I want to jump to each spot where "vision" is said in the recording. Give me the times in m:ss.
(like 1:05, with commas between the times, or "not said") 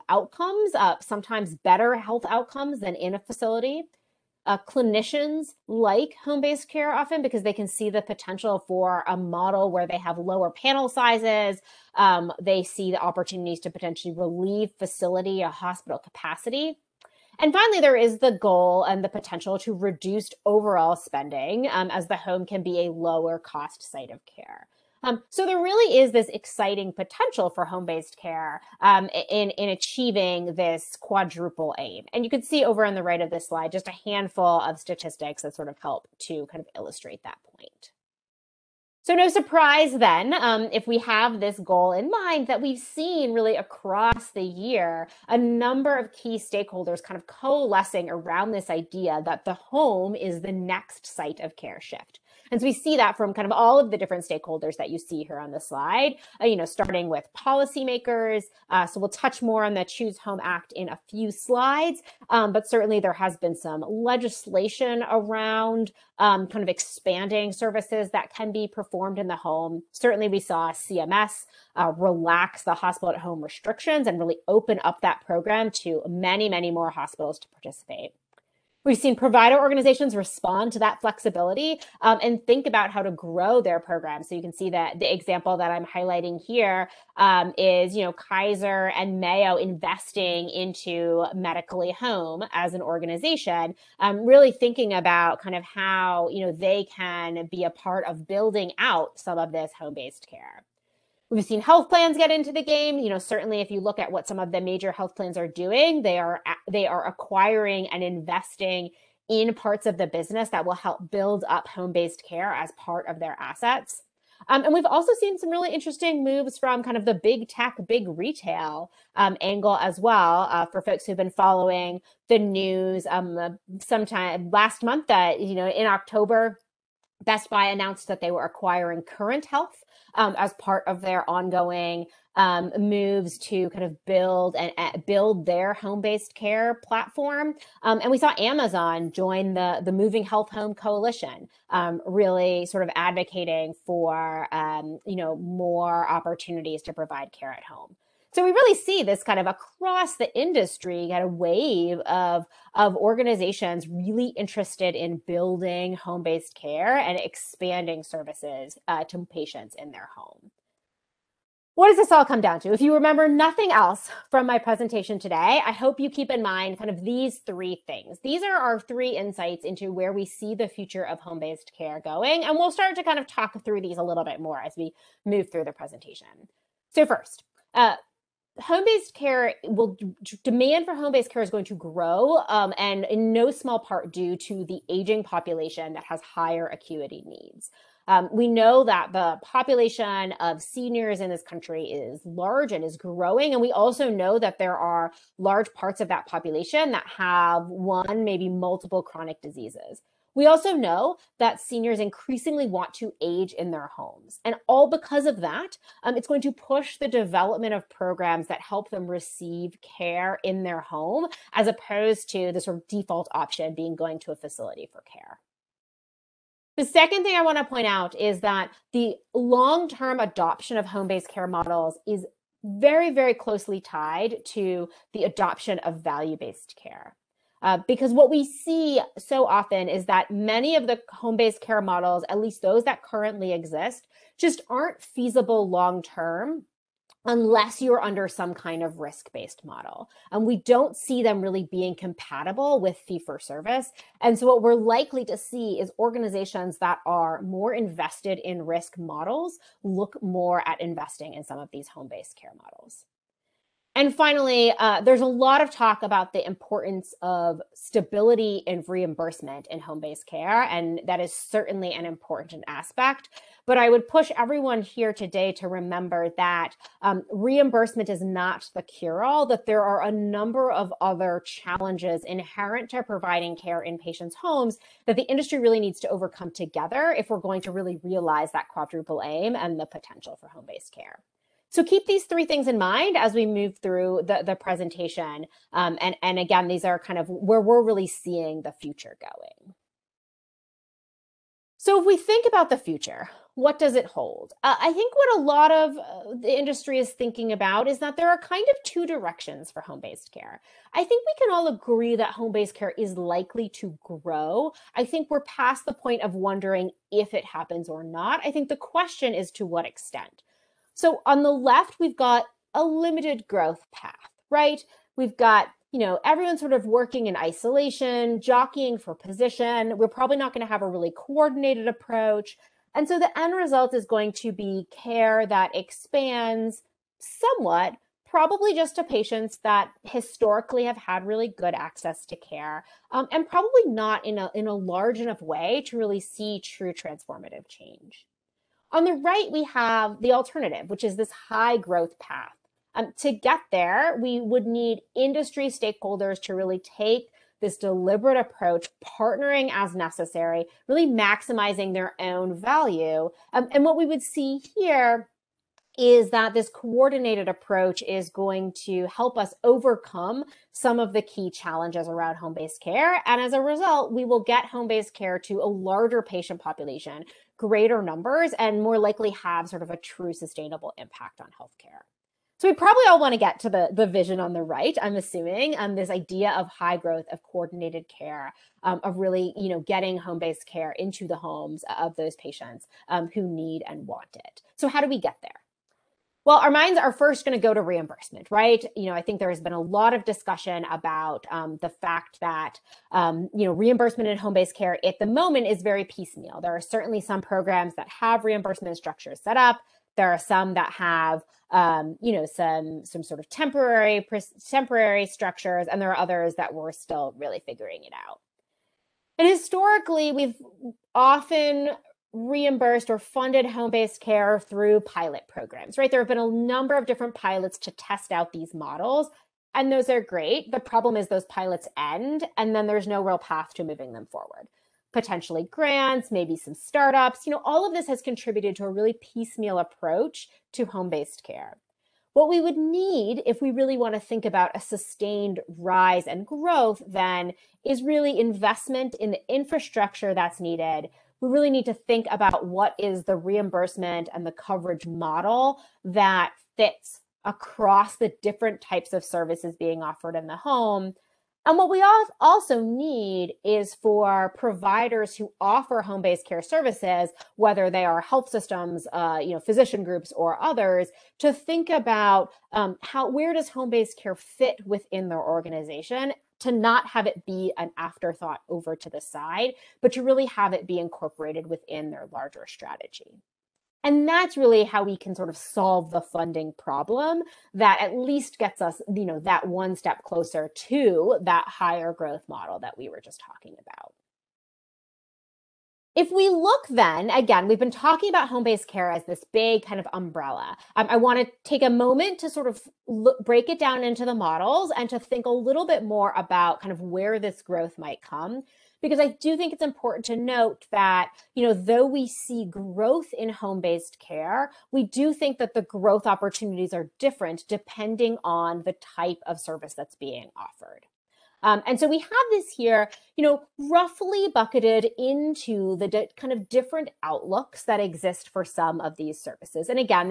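6:14.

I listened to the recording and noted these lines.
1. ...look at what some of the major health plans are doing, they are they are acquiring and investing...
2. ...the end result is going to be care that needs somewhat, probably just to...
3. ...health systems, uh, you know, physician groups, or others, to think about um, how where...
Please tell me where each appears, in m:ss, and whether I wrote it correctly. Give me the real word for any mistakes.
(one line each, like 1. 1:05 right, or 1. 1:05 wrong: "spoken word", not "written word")
1. 1:43 right
2. 5:23 wrong: "expands", not "needs"
3. 7:38 right.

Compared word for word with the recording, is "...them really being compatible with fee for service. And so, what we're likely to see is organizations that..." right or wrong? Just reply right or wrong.
right.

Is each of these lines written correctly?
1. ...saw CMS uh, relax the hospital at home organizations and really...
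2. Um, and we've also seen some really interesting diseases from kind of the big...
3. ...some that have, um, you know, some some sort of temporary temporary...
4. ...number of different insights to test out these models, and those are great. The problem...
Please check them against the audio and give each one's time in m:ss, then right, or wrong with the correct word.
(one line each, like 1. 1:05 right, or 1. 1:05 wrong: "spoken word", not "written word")
1. 1:10 wrong: "restrictions", not "organizations"
2. 1:54 wrong: "moves", not "diseases"
3. 6:40 right
4. 6:56 wrong: "pilots", not "insights".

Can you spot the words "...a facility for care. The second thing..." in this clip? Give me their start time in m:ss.
3:34.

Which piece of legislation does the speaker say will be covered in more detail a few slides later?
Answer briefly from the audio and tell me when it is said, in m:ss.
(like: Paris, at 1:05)
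Choose Home Act, at 0:59.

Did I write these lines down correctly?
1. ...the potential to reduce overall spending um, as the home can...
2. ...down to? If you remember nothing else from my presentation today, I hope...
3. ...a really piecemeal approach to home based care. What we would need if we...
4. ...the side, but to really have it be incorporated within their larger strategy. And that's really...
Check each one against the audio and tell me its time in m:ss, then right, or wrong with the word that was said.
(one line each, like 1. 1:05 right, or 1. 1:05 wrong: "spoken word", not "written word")
1. 0:19 right
2. 2:42 right
3. 7:08 right
4. 7:49 right.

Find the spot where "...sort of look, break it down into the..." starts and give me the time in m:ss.
8:12.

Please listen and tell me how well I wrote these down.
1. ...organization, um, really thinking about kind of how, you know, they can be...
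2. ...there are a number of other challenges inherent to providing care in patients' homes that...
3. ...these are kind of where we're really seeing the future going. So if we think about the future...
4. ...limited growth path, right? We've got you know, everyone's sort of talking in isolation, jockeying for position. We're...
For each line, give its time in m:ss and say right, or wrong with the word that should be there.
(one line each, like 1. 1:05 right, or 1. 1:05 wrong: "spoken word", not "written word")
1. 1:32 right
2. 4:29 right
3. 4:46 right
4. 5:12 wrong: "working", not "talking".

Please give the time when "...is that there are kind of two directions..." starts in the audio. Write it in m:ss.
4:57.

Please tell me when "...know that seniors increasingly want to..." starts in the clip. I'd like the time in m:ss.
3:20.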